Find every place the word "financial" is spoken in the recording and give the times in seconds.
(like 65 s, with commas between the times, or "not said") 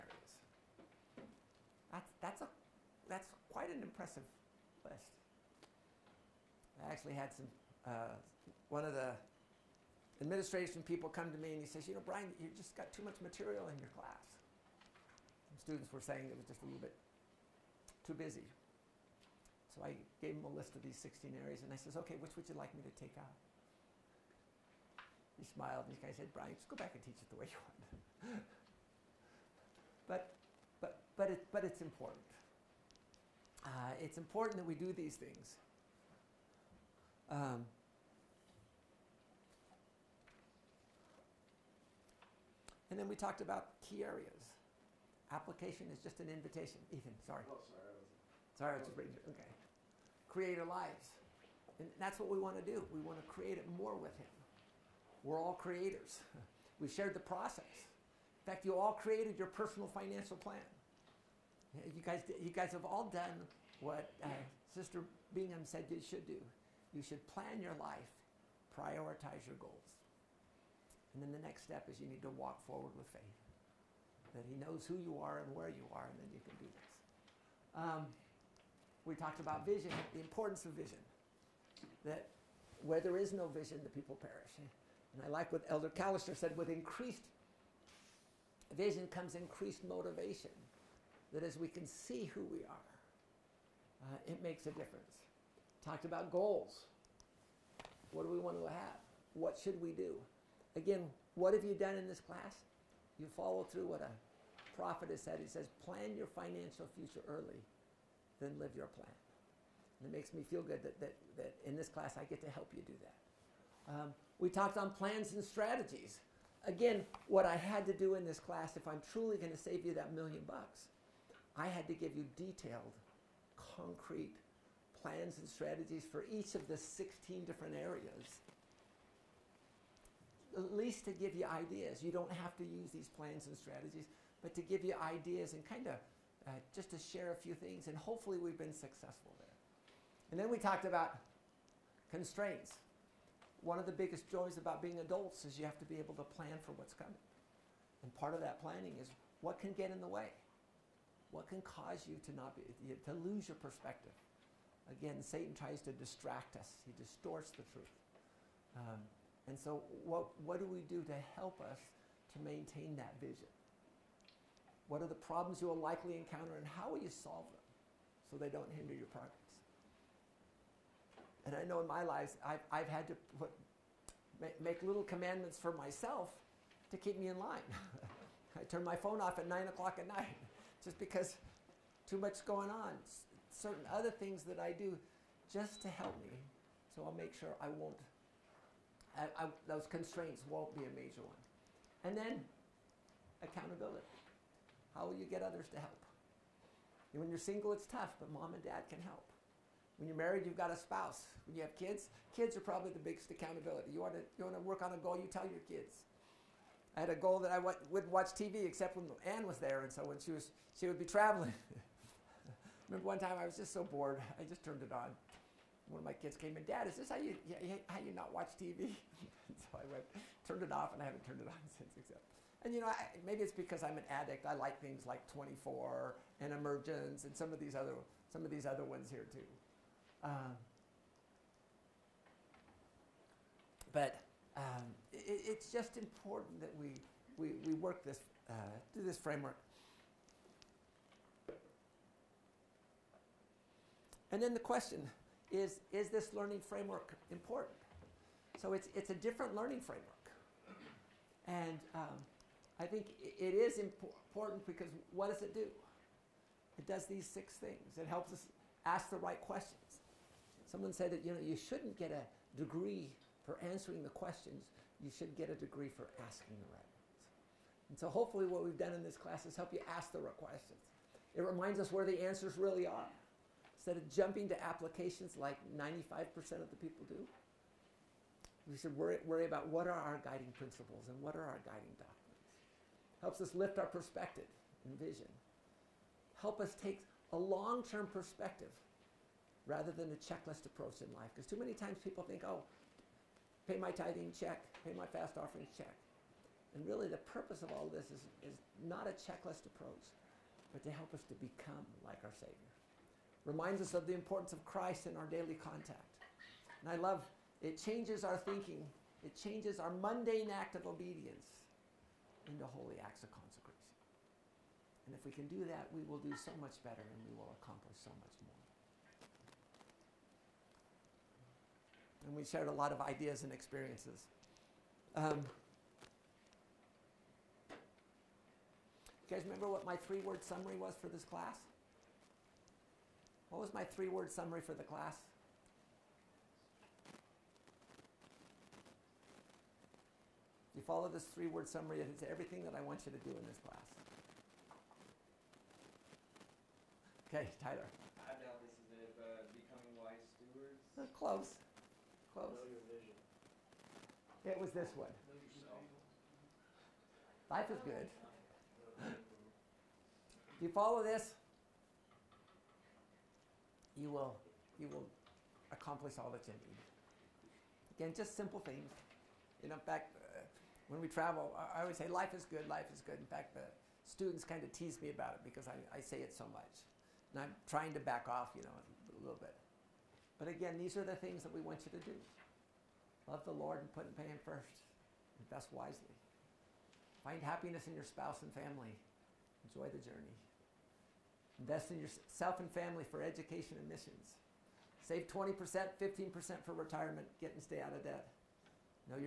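59 s, 106 s.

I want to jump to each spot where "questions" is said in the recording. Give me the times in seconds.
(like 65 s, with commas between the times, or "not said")
244 s, 259 s, 264 s, 270 s.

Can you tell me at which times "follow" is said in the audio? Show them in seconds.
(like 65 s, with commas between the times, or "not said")
103 s, 340 s, 360 s.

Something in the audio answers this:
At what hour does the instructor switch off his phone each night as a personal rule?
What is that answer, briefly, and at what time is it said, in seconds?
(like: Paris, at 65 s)
9 o'clock, at 179 s.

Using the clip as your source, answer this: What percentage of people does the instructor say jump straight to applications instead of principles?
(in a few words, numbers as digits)
95%.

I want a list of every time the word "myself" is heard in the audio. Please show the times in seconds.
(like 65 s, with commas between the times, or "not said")
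175 s.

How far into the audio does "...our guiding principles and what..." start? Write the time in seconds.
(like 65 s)
279 s.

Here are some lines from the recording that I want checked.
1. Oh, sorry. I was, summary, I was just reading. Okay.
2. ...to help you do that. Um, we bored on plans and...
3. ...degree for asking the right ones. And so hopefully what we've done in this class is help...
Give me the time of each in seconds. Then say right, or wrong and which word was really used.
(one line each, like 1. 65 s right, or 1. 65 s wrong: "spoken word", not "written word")
1. 47 s wrong: "sorry", not "summary"
2. 112 s wrong: "talked", not "bored"
3. 265 s right.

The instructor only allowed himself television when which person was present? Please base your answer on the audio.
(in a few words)
Anne.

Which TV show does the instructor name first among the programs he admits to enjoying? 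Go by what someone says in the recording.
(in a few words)
24.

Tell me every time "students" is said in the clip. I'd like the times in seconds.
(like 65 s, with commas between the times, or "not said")
15 s, 374 s.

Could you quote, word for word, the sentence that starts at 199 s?
When you're married, you've got a spouse.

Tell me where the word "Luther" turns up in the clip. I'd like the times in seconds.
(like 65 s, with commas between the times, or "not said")
not said.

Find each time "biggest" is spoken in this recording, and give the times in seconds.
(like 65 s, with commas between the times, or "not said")
143 s, 202 s.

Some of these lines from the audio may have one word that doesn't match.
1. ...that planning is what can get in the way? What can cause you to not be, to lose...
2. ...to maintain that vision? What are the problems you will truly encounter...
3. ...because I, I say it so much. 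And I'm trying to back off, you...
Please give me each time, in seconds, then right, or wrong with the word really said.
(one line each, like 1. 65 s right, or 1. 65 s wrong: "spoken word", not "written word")
1. 148 s right
2. 162 s wrong: "likely", not "truly"
3. 375 s right.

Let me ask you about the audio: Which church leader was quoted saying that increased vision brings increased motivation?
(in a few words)
Elder Callister.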